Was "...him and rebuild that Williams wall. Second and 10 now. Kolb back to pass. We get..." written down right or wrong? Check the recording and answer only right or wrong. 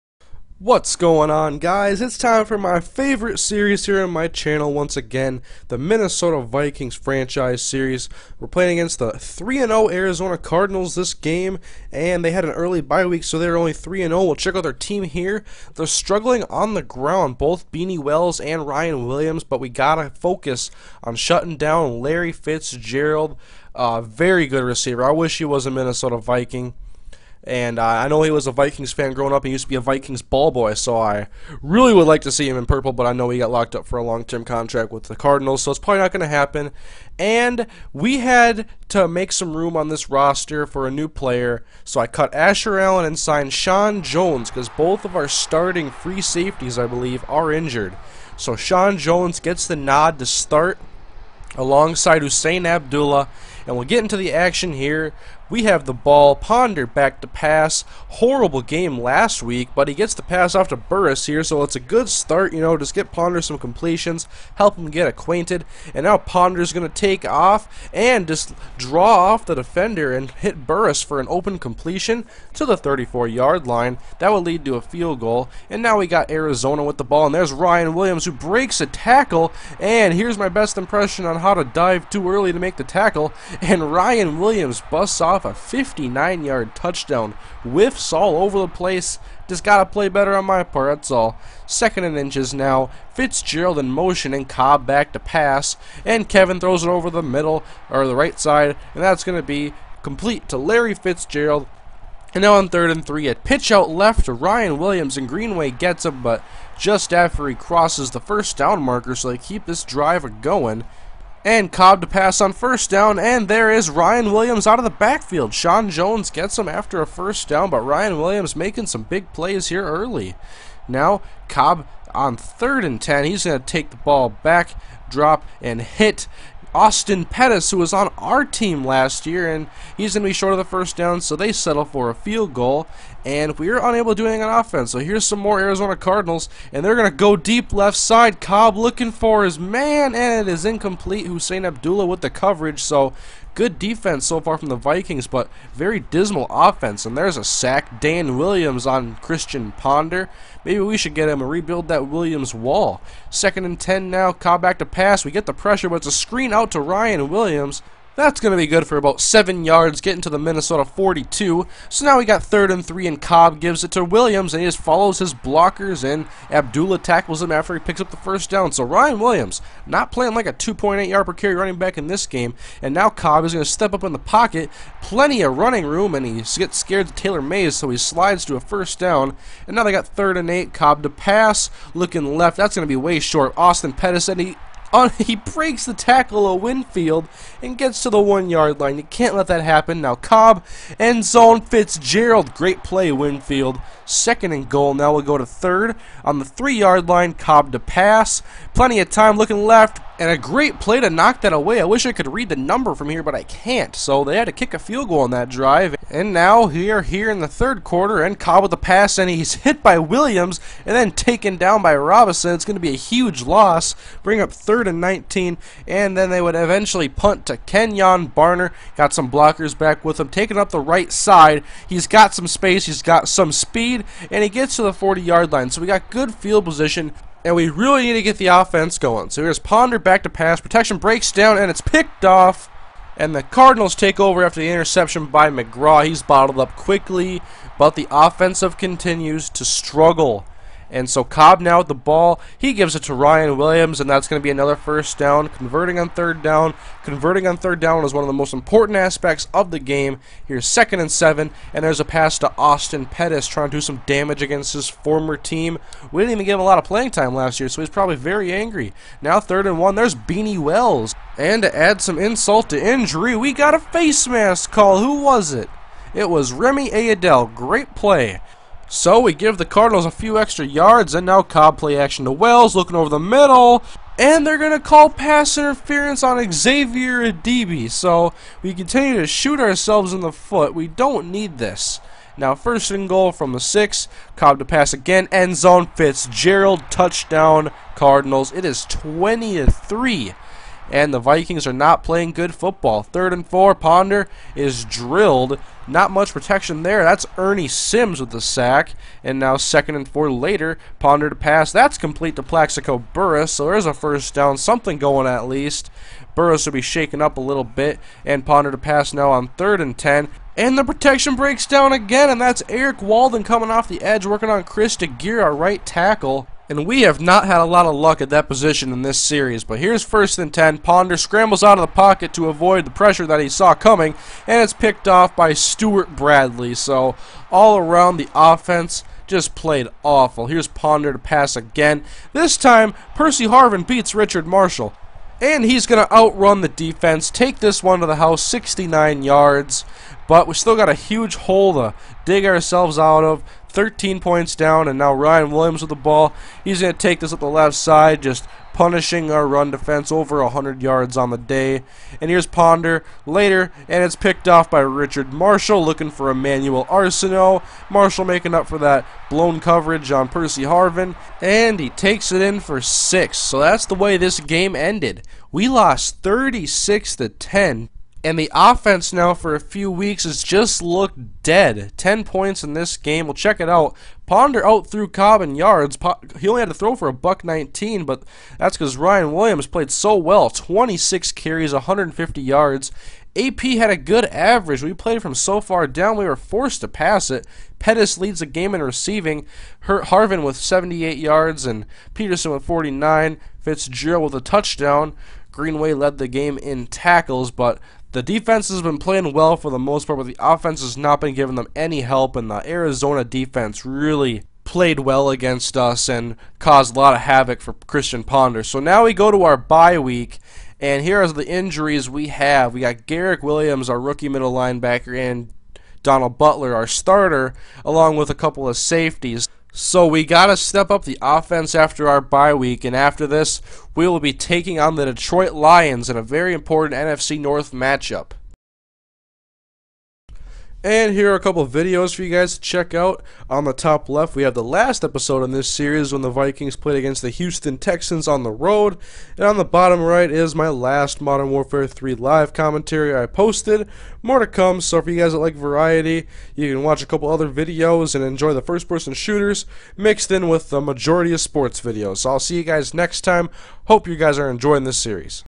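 right.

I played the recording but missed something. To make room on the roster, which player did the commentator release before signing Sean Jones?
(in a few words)
Asher Allen.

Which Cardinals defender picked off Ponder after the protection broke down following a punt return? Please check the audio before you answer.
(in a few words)
McGraw.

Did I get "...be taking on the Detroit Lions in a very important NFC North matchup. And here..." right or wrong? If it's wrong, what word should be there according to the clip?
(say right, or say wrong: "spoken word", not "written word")
right.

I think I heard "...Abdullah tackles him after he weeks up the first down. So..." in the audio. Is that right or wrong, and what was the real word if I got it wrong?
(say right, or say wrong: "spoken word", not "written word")
wrong: "picks", not "weeks".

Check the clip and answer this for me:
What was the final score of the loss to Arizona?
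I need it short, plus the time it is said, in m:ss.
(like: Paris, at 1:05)
36 to 10, at 6:06.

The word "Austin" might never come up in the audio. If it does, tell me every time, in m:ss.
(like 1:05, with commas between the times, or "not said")
2:06, 3:03, 4:12.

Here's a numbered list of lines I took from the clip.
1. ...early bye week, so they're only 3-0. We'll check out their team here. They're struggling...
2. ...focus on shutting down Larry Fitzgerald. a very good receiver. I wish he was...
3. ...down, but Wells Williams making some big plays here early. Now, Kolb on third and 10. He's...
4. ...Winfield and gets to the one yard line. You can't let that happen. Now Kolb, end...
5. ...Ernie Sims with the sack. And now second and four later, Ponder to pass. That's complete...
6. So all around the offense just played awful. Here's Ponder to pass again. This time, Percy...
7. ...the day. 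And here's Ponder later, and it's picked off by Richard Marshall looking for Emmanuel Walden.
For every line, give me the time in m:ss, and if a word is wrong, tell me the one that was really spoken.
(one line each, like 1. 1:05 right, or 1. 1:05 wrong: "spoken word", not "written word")
1. 0:12 right
2. 0:20 right
3. 1:57 wrong: "Ryan", not "Wells"
4. 3:06 right
5. 4:57 right
6. 5:26 right
7. 5:51 wrong: "Arceneaux", not "Walden".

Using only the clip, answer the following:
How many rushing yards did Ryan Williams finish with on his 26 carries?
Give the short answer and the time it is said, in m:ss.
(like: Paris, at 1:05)
150, at 6:21.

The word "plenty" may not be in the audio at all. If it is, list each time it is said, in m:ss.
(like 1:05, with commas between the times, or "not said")
2:55, 3:18.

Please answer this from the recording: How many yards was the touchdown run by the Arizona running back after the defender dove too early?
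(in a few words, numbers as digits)
59.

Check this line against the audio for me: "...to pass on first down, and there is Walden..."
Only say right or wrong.
wrong.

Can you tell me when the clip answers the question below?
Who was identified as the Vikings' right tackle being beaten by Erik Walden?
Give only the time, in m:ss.
5:14.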